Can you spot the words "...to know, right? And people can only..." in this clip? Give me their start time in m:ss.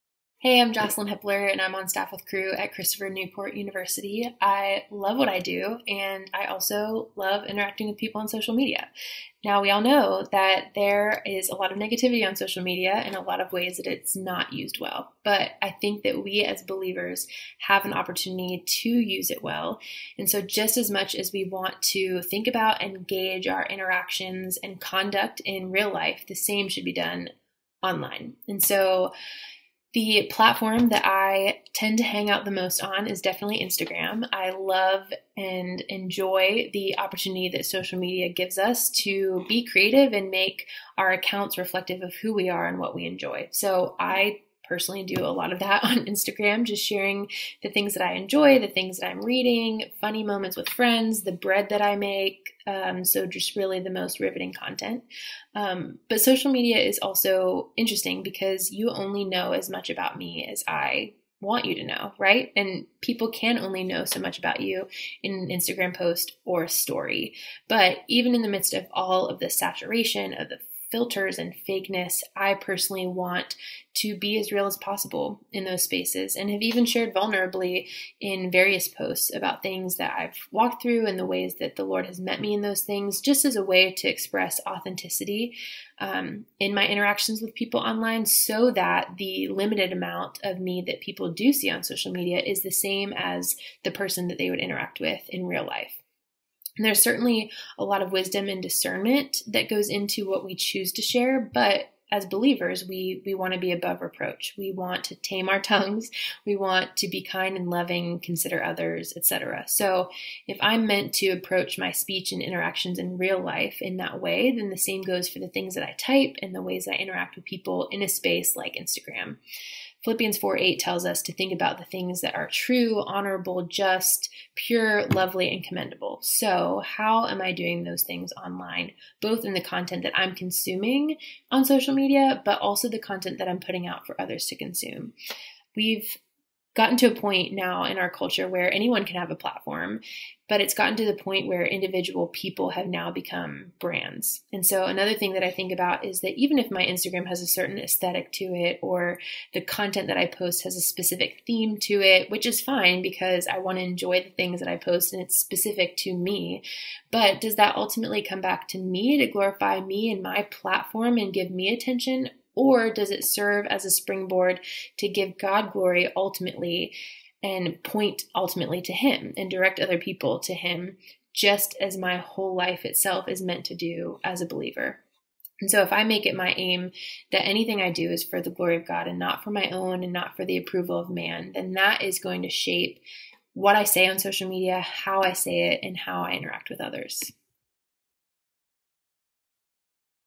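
1:01.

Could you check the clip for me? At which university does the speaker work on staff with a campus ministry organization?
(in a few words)
Christopher Newport University.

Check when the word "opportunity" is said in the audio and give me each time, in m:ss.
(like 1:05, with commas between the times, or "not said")
0:17, 0:36.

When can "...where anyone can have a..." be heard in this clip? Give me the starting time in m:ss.
2:18.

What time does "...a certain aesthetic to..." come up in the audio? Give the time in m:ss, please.
2:27.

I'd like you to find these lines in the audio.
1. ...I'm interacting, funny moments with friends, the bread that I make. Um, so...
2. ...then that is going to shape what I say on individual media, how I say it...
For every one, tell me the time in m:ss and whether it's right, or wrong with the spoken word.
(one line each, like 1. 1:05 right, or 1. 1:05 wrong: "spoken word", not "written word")
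1. 0:49 wrong: "reading", not "interacting"
2. 3:01 wrong: "social", not "individual".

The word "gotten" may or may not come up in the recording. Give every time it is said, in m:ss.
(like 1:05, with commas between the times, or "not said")
2:16, 2:20.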